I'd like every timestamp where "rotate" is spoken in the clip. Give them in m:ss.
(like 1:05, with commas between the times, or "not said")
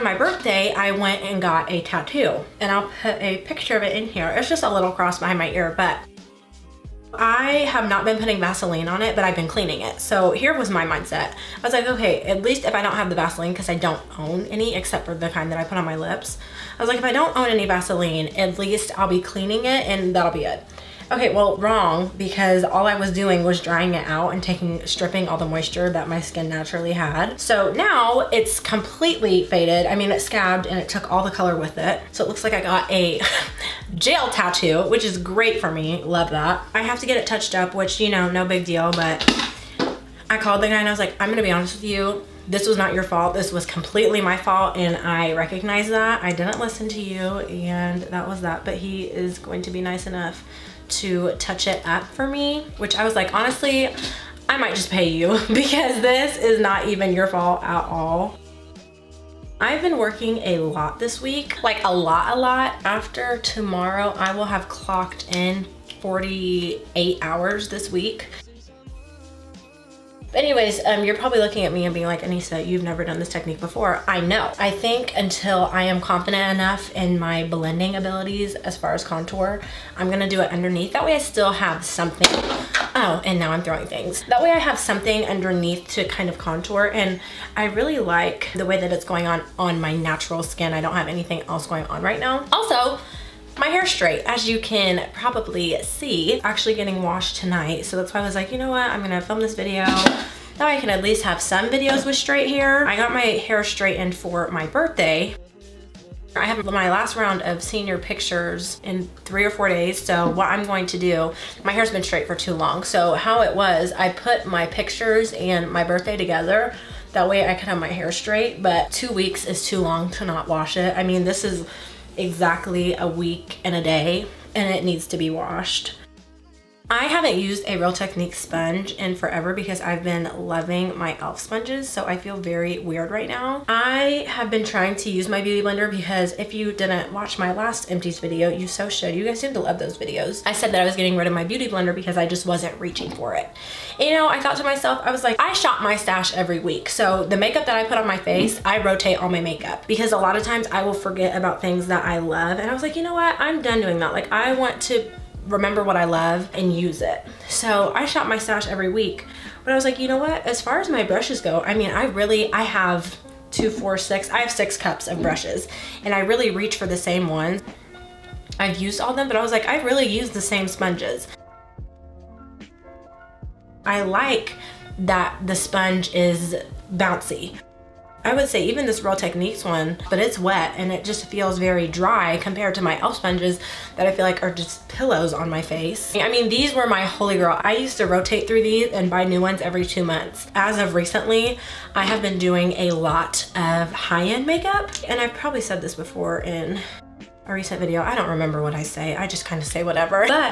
2:28, 3:08.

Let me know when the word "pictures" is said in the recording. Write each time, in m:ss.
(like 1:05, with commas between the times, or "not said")
0:03, 1:47, 1:54.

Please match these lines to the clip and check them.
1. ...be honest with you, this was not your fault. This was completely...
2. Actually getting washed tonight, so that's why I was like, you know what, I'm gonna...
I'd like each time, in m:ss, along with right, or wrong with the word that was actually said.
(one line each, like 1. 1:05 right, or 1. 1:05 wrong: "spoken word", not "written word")
1. 0:41 right
2. 1:36 right.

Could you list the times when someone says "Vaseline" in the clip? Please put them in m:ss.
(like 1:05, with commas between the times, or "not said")
0:08, 0:13, 0:17.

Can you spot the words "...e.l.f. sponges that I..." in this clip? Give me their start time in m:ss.
3:02.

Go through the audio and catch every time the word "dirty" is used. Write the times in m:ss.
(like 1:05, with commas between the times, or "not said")
not said.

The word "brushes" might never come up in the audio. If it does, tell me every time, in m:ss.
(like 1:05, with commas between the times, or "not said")
2:41, 2:45.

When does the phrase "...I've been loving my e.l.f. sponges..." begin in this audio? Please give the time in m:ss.
2:09.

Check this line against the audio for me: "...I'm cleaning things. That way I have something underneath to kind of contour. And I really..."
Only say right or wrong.
wrong.